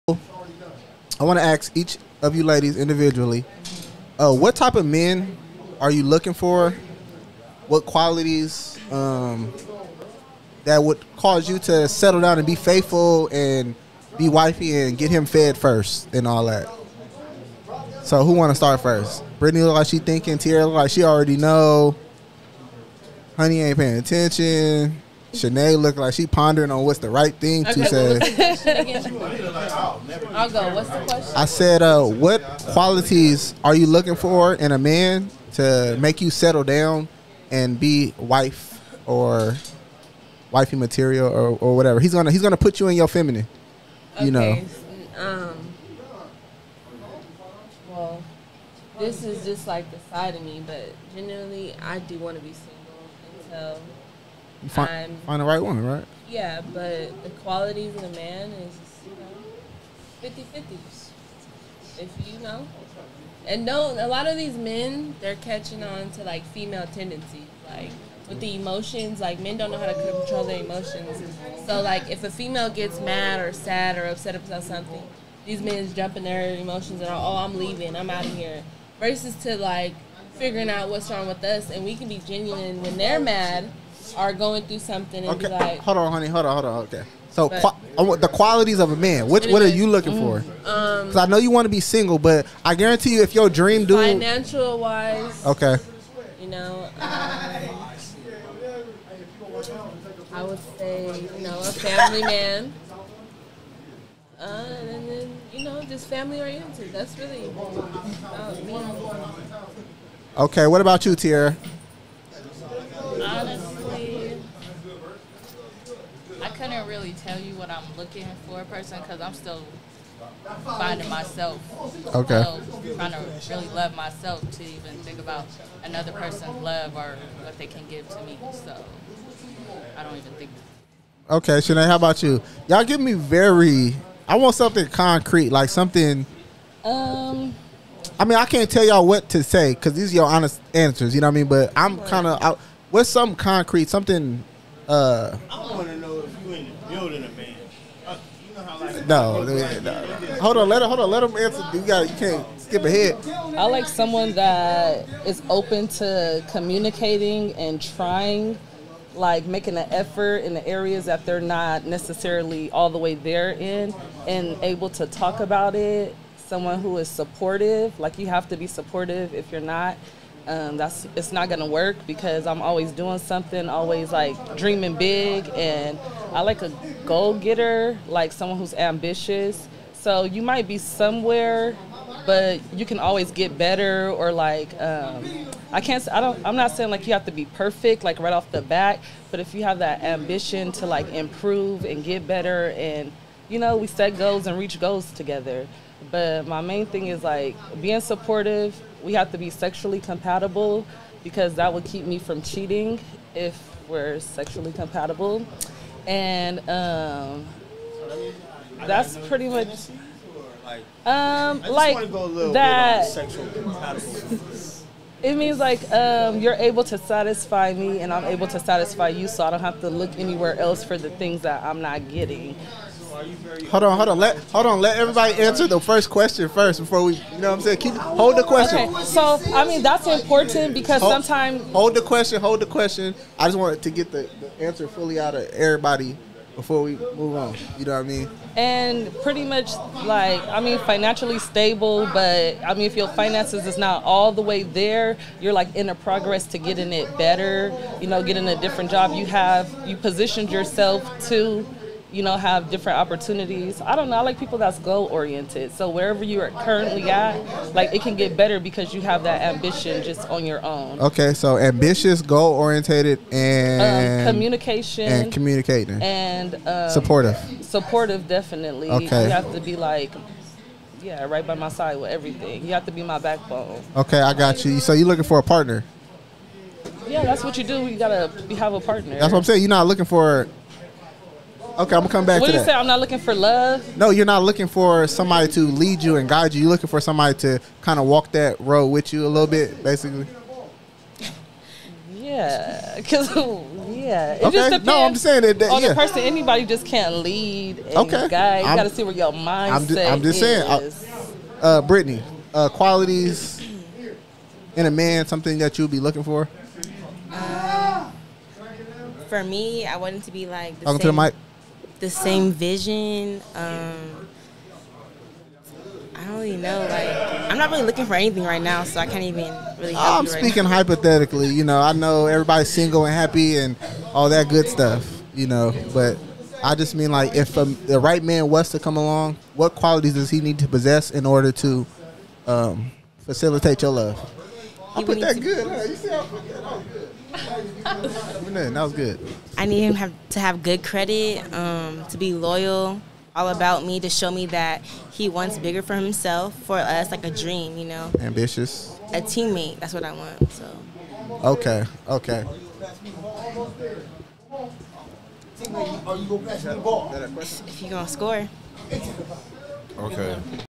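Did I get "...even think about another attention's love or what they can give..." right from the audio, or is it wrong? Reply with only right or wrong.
wrong.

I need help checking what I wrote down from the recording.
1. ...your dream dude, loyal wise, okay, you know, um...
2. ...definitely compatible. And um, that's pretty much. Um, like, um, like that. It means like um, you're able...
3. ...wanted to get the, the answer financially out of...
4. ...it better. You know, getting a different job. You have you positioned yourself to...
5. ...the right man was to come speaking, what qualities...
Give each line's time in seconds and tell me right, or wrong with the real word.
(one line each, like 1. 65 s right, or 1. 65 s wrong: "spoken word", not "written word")
1. 93 s wrong: "financial", not "loyal"
2. 204 s wrong: "sexually", not "definitely"
3. 233 s wrong: "fully", not "financially"
4. 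246 s right
5. 327 s wrong: "along", not "speaking".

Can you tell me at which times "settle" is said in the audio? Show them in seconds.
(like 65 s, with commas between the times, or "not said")
11 s, 36 s.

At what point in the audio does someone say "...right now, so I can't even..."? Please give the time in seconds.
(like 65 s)
318 s.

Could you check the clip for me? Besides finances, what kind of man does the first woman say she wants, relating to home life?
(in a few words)
A family man.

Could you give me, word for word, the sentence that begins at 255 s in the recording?
So wherever you are currently at, like it can get better because you have that ambition just on your own.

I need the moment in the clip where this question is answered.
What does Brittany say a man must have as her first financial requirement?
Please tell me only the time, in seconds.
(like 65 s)
340 s.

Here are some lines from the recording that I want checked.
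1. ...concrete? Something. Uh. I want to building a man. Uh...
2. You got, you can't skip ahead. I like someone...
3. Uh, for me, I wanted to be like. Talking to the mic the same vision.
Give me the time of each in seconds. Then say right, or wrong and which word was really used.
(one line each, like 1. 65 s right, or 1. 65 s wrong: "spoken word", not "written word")
1. 143 s right
2. 151 s right
3. 307 s right.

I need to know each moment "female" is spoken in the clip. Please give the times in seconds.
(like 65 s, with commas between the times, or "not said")
66 s, 72 s.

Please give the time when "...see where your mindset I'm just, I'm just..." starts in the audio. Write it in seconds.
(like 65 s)
298 s.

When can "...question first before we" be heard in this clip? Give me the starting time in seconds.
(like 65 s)
226 s.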